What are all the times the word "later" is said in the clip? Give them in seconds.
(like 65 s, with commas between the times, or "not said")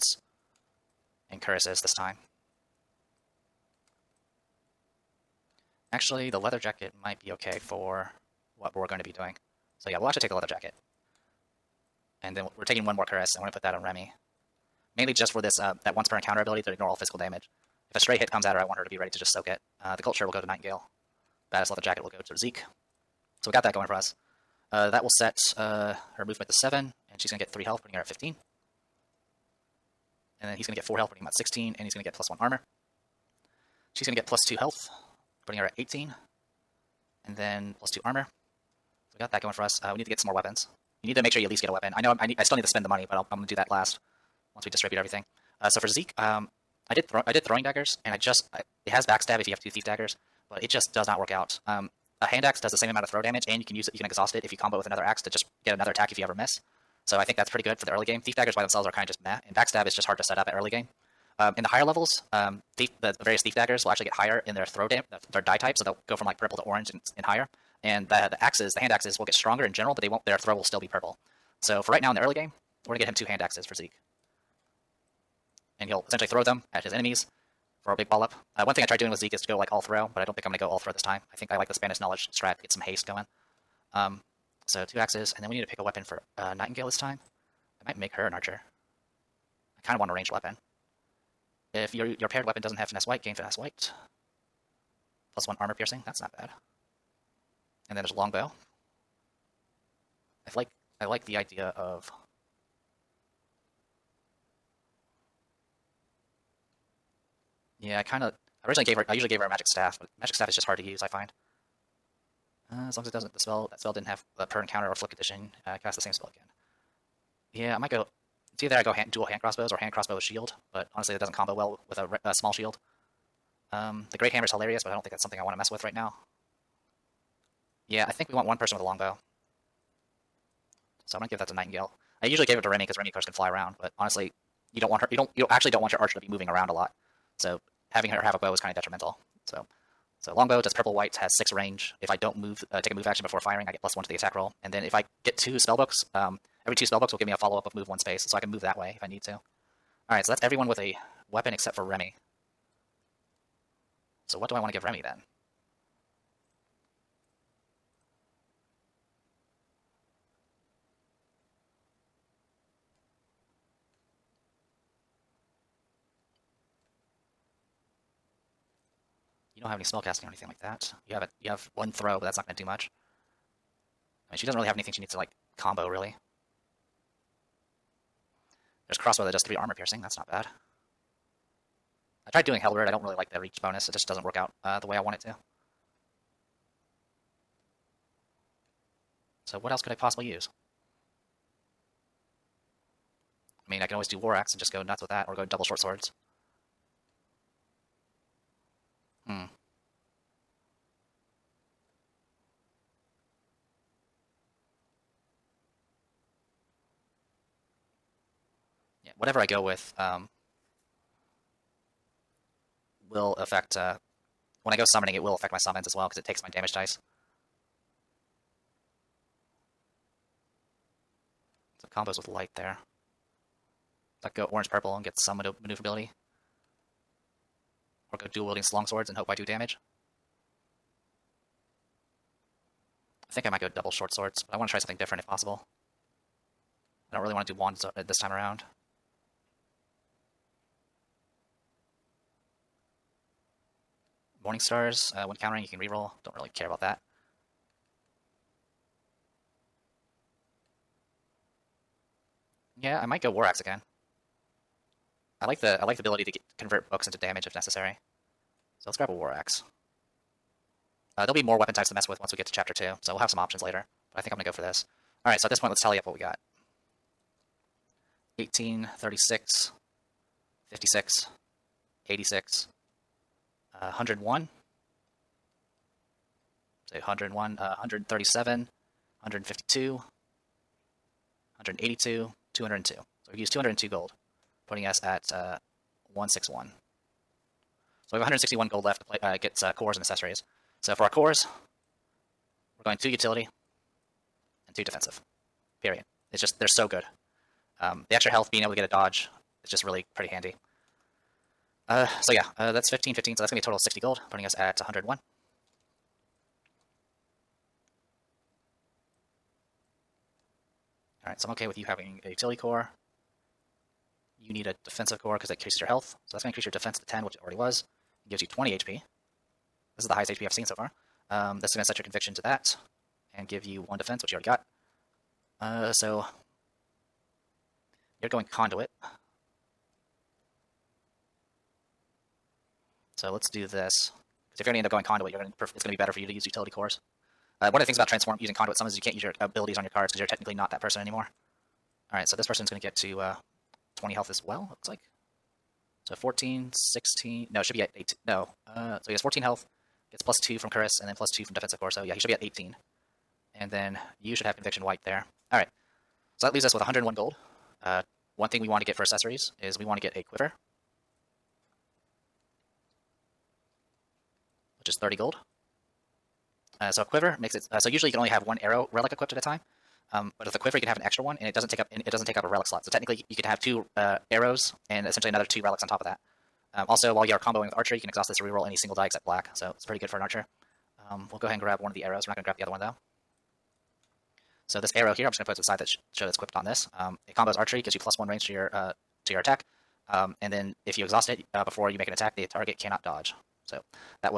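263 s.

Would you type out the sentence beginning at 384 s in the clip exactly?
So this arrow here, I'm just going to put it to the side that sh show that's equipped on this.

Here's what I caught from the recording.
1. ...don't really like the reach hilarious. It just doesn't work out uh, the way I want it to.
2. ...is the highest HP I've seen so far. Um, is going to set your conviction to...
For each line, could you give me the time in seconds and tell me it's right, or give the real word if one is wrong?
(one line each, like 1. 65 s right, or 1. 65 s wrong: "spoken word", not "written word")
1. 182 s wrong: "bonus", not "hilarious"
2. 320 s right.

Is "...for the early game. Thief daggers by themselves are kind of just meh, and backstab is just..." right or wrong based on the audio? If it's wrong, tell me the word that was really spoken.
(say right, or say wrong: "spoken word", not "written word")
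right.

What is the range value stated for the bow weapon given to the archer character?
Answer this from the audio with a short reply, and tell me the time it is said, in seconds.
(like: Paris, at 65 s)
6, at 141 s.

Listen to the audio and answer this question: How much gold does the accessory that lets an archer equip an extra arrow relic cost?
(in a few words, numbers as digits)
30 gold.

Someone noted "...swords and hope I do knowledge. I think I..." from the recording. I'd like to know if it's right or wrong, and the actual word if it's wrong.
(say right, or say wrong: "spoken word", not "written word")
wrong: "damage", not "knowledge".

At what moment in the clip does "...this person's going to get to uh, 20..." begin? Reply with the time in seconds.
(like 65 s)
342 s.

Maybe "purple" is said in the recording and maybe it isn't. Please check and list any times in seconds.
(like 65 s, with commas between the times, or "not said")
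66 s, 70 s, 140 s, 224 s.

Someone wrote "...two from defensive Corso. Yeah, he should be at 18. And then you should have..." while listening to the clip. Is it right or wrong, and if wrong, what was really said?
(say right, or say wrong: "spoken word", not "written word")
right.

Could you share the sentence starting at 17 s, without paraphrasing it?
If a stray hit comes at her, I want her to be ready to just soak it.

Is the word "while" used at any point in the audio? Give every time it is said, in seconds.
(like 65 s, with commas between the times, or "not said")
377 s.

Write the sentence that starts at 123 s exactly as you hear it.
Um, the Great Hammer is hilarious, but I don't think that's something I want to mess with right now.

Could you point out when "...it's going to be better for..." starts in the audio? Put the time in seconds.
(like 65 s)
335 s.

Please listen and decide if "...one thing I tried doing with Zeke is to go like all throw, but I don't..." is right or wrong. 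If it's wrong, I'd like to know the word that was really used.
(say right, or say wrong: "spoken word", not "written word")
right.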